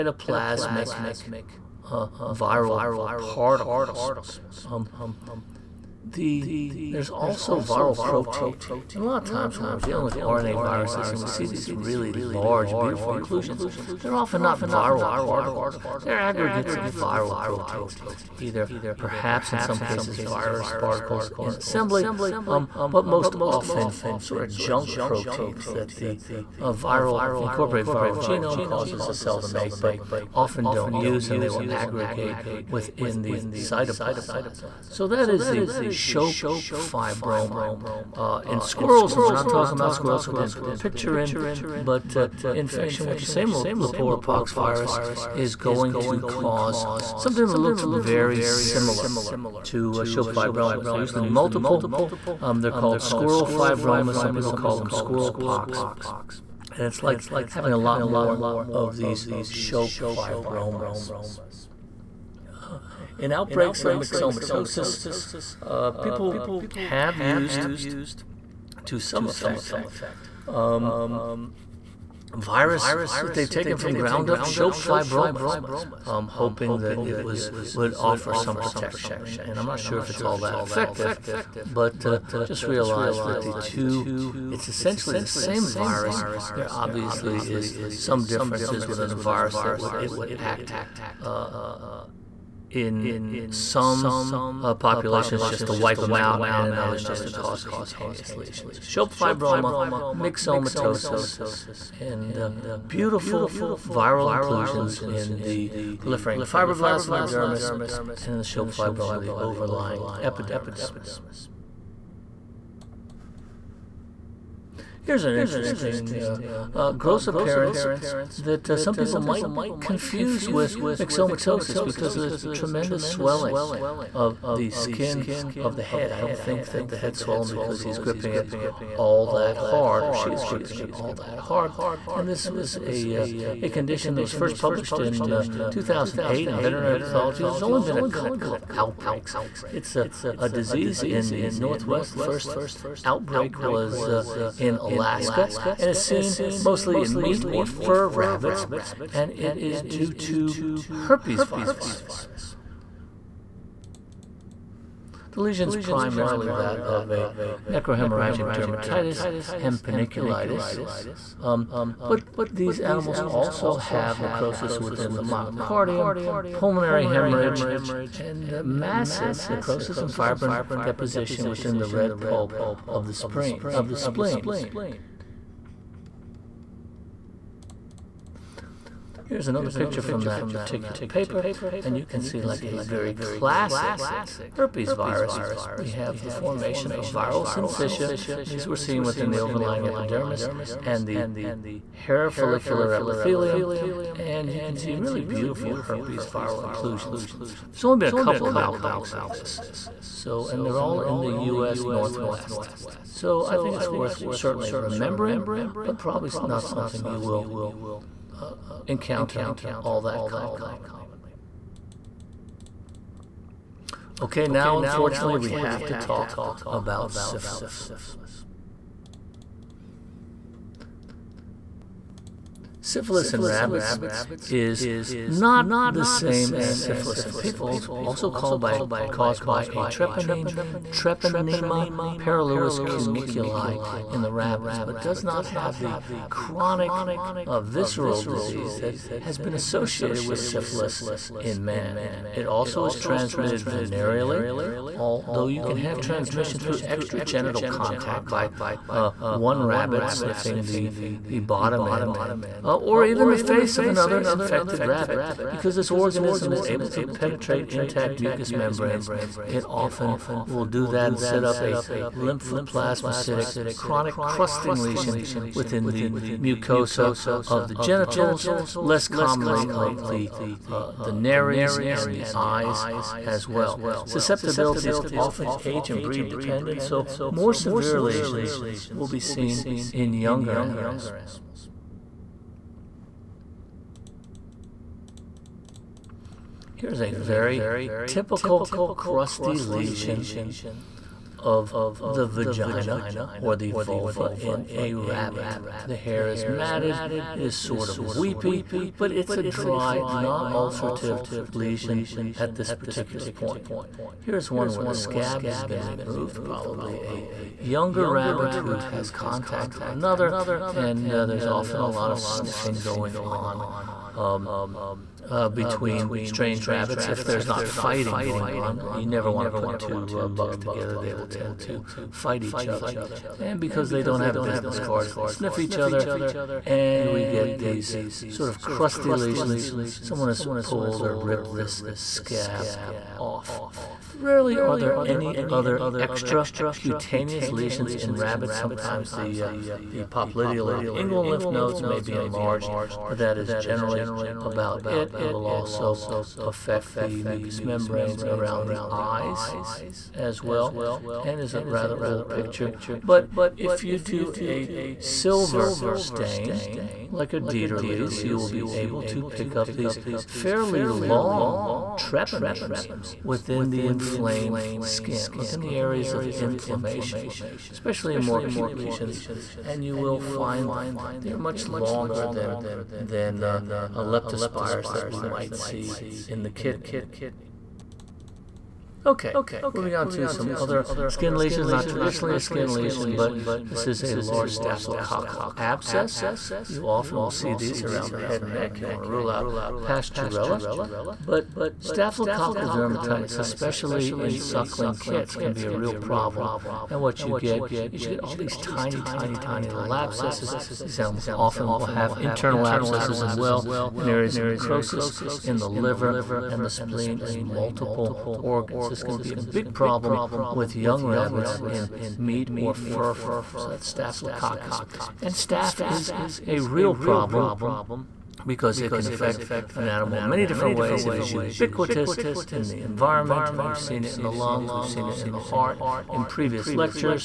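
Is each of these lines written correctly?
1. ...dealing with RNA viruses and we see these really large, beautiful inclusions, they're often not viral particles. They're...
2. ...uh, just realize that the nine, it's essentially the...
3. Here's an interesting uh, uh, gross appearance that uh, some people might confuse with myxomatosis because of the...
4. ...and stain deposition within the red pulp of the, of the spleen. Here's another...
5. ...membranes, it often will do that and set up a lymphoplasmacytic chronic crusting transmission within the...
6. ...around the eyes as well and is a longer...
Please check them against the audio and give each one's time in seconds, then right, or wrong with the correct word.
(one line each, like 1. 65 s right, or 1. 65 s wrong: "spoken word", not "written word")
1. 9 s right
2. 82 s wrong: "two", not "nine"
3. 115 s right
4. 170 s wrong: "fibrin", not "stain"
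5. 258 s wrong: "lesion", not "transmission"
6. 348 s wrong: "rather", not "longer".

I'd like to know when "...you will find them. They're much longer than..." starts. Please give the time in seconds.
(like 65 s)
369 s.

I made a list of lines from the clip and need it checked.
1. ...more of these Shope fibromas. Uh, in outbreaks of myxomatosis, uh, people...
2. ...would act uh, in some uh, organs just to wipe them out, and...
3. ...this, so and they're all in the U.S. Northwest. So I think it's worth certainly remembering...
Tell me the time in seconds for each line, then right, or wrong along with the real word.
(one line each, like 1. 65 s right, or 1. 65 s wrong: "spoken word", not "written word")
1. 58 s right
2. 90 s wrong: "populations", not "organs"
3. 199 s right.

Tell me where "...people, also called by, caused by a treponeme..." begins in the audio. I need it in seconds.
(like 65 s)
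227 s.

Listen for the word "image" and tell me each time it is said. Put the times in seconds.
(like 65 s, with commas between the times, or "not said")
not said.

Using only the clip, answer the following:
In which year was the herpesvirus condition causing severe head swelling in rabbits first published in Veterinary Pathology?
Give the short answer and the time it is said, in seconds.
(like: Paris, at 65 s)
2008, at 135 s.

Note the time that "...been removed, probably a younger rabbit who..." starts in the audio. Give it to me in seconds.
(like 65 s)
305 s.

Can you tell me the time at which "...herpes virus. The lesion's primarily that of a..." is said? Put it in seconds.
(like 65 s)
150 s.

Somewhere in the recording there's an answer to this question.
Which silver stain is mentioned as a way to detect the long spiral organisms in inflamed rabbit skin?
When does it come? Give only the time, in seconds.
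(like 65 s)
357 s.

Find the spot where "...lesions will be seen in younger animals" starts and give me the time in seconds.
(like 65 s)
278 s.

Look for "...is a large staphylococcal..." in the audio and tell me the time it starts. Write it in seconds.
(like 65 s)
383 s.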